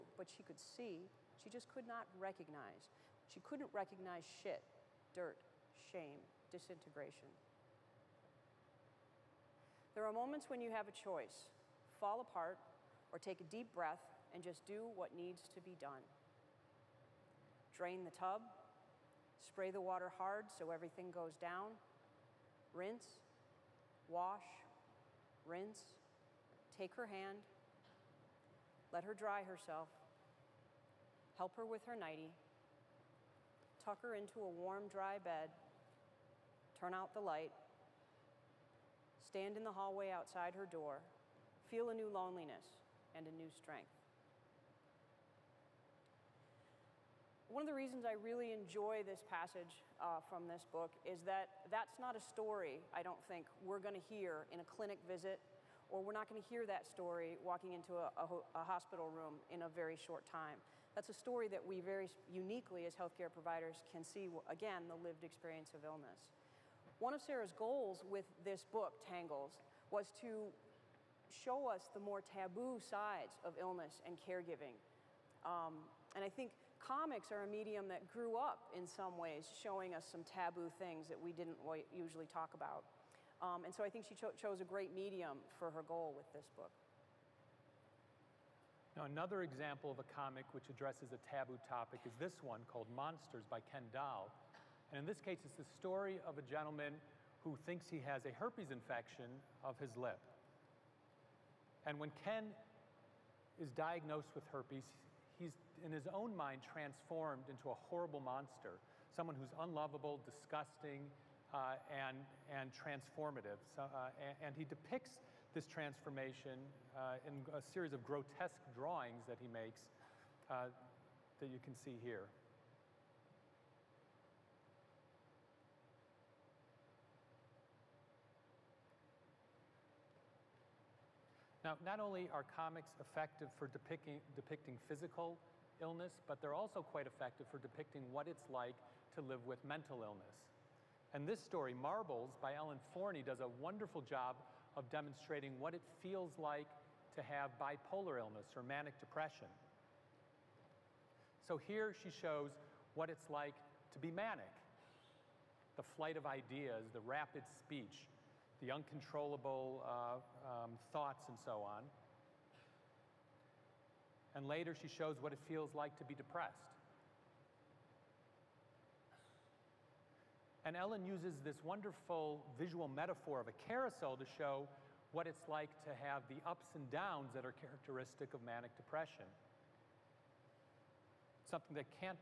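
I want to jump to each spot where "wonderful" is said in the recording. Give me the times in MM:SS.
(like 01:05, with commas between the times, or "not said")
02:23, 02:51.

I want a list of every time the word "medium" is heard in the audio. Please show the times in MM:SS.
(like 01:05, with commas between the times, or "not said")
01:17, 01:24.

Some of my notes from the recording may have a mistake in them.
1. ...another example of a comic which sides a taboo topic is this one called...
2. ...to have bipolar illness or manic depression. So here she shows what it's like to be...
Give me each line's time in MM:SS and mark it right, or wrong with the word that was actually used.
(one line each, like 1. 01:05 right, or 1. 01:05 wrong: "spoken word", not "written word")
1. 01:29 wrong: "addresses", not "sides"
2. 02:27 right.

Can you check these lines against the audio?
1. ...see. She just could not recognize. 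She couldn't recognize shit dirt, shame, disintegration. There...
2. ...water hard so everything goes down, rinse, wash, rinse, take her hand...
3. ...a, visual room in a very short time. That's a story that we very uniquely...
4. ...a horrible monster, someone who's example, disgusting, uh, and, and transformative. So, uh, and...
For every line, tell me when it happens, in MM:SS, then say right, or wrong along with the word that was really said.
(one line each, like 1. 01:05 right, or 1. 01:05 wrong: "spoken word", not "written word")
1. 00:00 right
2. 00:19 right
3. 00:58 wrong: "hospital", not "visual"
4. 01:47 wrong: "unlovable", not "example".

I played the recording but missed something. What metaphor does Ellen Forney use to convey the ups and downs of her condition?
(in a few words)
A carousel.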